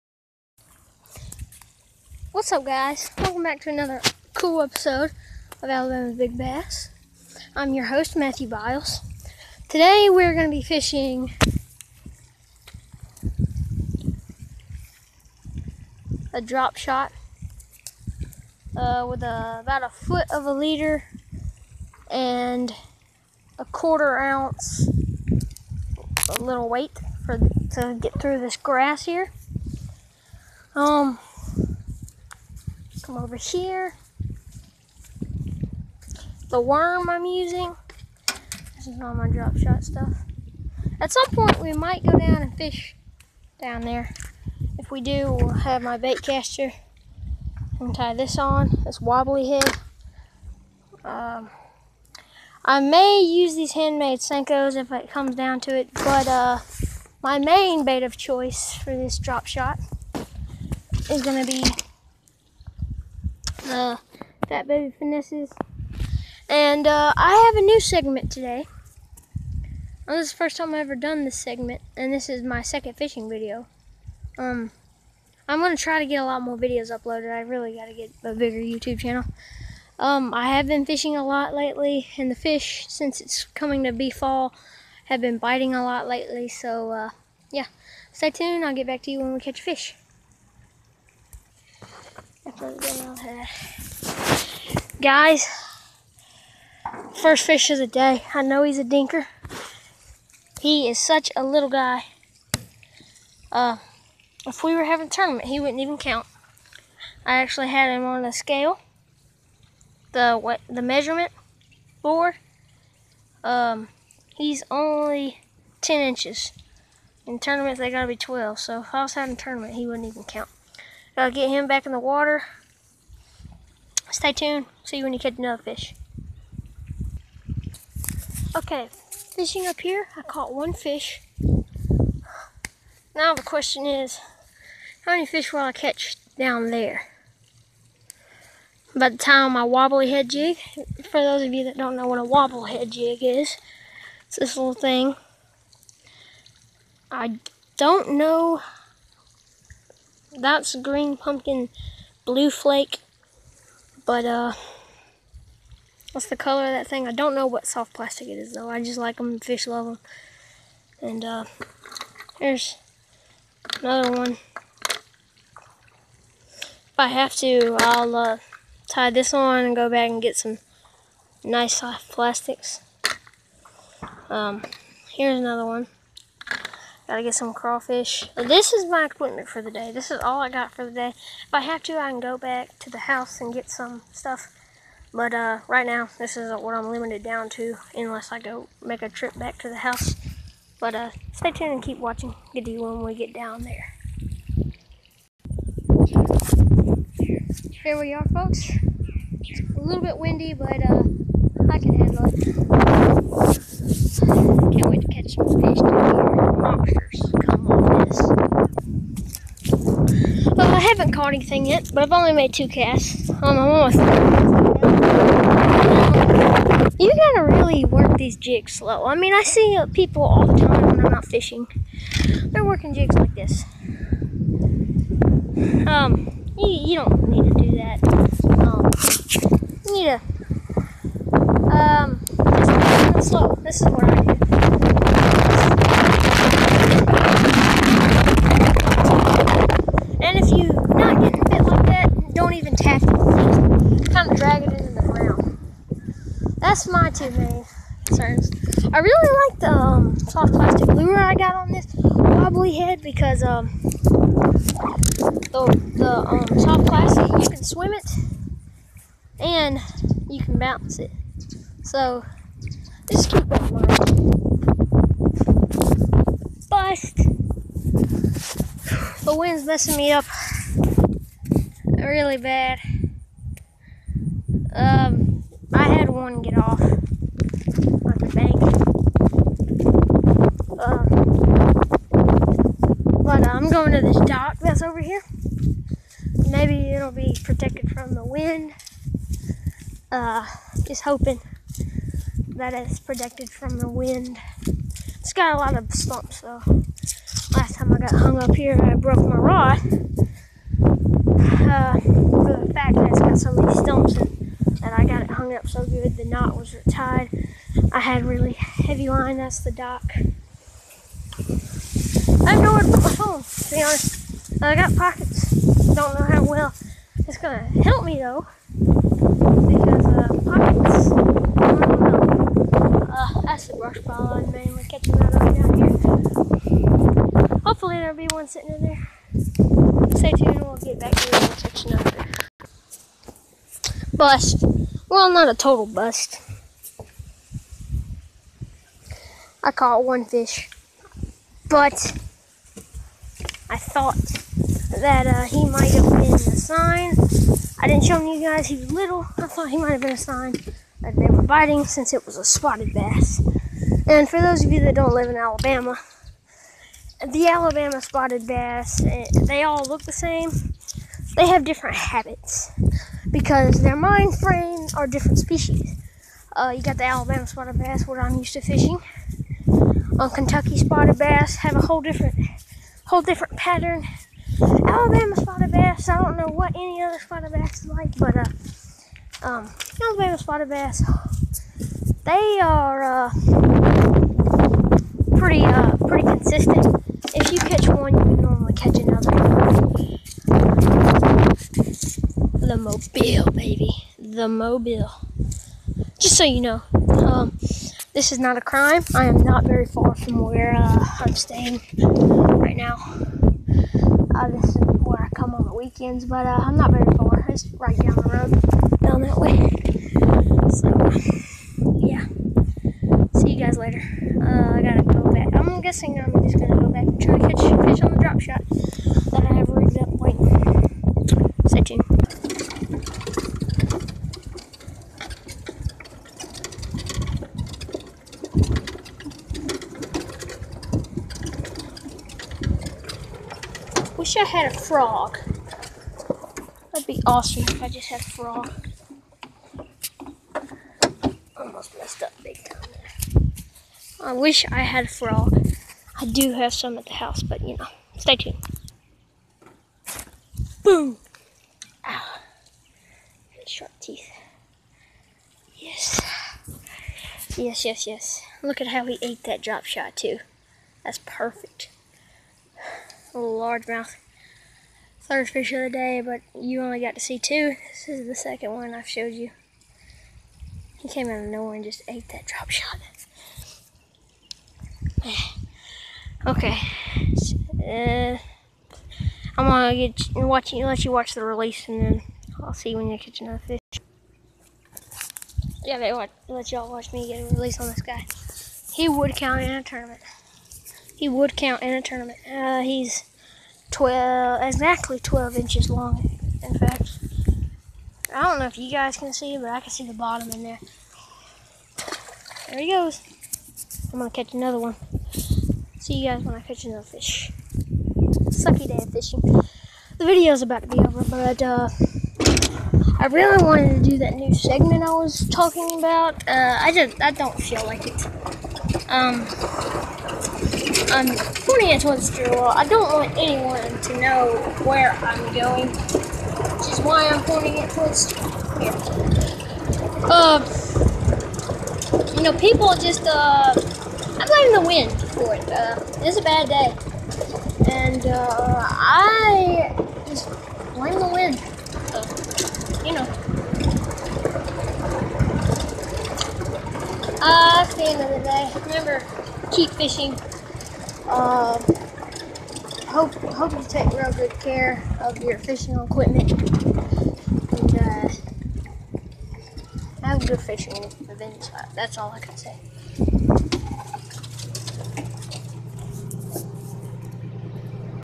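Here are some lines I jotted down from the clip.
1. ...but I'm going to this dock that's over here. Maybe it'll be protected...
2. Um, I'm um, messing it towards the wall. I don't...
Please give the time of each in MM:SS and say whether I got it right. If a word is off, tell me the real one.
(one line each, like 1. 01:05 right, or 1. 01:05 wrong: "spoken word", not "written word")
1. 04:43 right
2. 08:39 wrong: "pointing", not "messing".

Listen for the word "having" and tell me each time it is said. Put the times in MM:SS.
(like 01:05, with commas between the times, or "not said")
01:44, 01:59.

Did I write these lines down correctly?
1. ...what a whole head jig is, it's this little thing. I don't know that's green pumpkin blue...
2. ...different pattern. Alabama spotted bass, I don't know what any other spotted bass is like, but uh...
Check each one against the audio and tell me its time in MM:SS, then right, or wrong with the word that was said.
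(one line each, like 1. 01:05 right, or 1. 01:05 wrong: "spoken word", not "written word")
1. 02:22 wrong: "wobble", not "whole"
2. 06:13 right.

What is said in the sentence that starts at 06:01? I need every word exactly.
They have different habits because their mind frame are different species.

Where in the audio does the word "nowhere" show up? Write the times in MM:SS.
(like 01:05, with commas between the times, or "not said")
05:12, 07:51.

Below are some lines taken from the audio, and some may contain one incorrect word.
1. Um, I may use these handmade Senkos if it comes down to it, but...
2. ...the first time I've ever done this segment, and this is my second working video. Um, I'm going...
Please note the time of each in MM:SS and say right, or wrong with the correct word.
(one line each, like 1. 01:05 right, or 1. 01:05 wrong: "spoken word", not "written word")
1. 00:51 right
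2. 01:10 wrong: "fishing", not "working".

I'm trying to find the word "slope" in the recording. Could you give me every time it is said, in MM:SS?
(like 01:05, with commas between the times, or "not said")
not said.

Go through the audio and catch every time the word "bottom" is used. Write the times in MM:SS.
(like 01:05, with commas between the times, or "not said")
08:20.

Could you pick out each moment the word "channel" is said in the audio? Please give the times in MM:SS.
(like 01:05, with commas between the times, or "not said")
01:18.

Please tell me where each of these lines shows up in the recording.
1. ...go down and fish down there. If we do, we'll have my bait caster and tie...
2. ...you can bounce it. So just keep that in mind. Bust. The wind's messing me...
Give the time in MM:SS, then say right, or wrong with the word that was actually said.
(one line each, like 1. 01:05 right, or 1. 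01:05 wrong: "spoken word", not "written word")
1. 00:42 right
2. 04:20 right.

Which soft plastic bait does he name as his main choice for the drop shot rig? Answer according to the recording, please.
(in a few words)
Fat Baby Finesses.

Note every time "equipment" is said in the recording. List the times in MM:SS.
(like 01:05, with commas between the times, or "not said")
02:59, 09:15.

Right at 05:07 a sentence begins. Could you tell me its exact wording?
I had really heavy line, that's the dock.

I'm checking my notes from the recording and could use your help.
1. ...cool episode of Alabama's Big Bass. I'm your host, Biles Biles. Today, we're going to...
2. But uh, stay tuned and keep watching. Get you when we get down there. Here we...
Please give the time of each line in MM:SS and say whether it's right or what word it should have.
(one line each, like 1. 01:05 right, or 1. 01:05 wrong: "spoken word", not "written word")
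1. 00:04 wrong: "Matthew", not "Biles"
2. 03:10 right.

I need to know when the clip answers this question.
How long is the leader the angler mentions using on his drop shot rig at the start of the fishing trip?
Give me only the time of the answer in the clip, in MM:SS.
00:19.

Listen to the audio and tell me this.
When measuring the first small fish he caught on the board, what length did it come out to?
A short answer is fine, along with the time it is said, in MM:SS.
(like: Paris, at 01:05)
10 inches, at 01:55.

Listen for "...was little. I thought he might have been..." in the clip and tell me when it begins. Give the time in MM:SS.
05:48.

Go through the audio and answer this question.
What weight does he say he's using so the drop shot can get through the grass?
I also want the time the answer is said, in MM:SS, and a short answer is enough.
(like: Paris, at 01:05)
quarter ounce, at 00:23.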